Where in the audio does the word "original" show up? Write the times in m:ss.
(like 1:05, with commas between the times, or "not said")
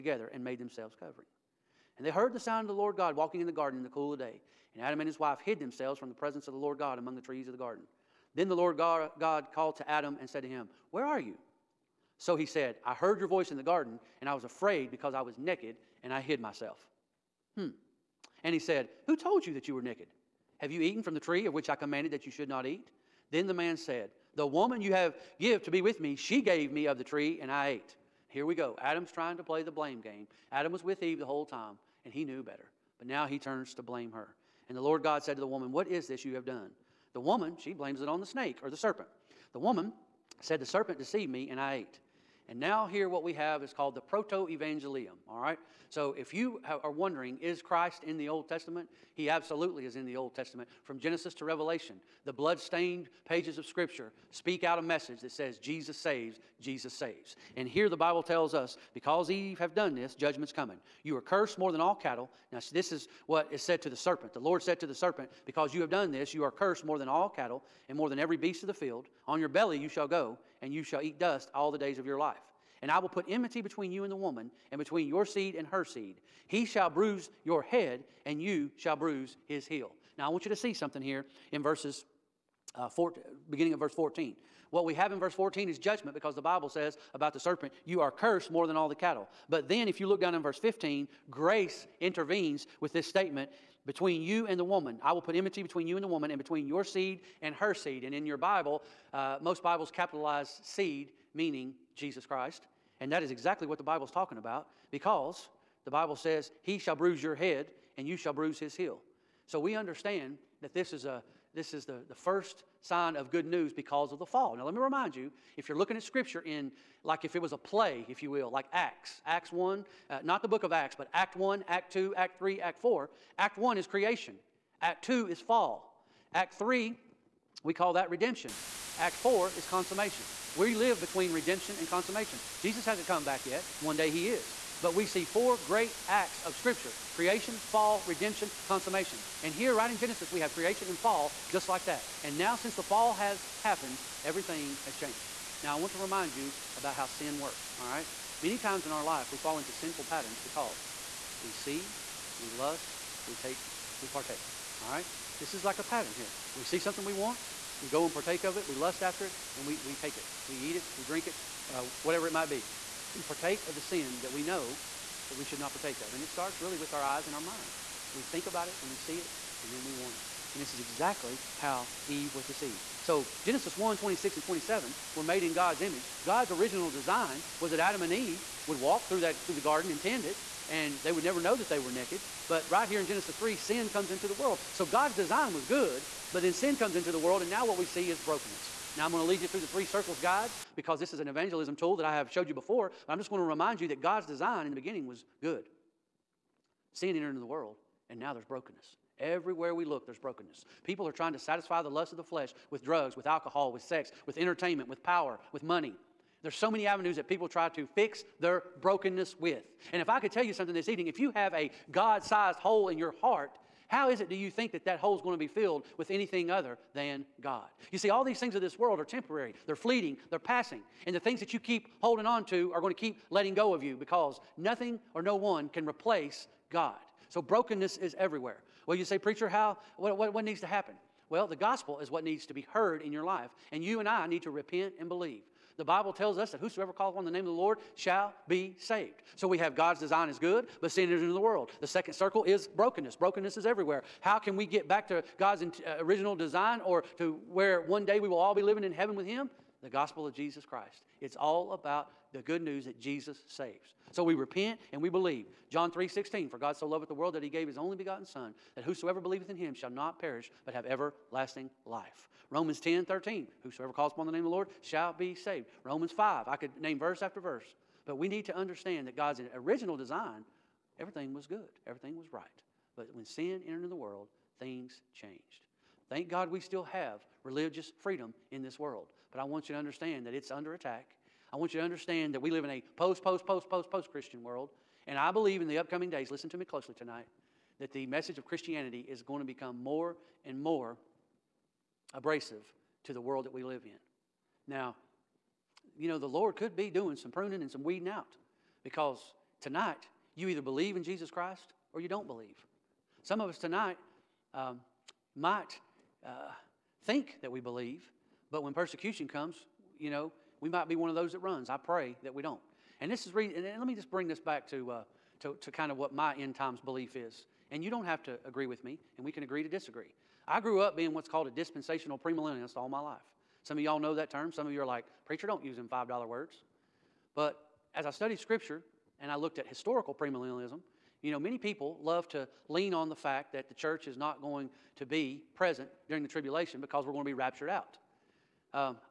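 2:56, 4:05, 4:29.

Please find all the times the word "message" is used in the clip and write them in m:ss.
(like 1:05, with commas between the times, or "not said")
0:54, 4:48.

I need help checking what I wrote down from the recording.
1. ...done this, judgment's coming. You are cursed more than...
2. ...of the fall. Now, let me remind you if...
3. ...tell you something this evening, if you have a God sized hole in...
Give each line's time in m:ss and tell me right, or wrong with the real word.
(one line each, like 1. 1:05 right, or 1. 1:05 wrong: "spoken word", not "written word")
1. 0:59 right
2. 1:54 right
3. 3:30 right.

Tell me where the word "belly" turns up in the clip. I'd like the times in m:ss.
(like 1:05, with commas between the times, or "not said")
1:09.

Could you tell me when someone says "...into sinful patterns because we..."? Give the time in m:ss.
2:29.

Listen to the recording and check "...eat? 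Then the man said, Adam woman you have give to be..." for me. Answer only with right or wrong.
wrong.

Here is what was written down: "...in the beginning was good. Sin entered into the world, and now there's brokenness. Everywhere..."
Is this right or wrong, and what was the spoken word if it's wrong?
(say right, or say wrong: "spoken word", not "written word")
right.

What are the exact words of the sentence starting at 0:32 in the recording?
But now he turns to blame her.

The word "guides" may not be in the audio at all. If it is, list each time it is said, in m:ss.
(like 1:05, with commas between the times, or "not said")
3:10.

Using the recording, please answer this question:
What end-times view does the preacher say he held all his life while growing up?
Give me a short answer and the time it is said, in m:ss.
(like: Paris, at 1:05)
dispensational premillennialist, at 5:21.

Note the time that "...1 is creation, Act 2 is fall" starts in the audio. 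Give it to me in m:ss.
2:03.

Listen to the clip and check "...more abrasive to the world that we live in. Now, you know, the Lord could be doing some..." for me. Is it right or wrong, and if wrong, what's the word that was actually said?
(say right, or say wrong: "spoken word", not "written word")
right.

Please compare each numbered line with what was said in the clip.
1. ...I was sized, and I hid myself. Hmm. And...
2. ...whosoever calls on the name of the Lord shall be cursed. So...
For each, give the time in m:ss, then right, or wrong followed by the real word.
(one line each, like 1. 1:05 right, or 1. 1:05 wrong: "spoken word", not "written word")
1. 0:15 wrong: "naked", not "sized"
2. 3:56 wrong: "saved", not "cursed".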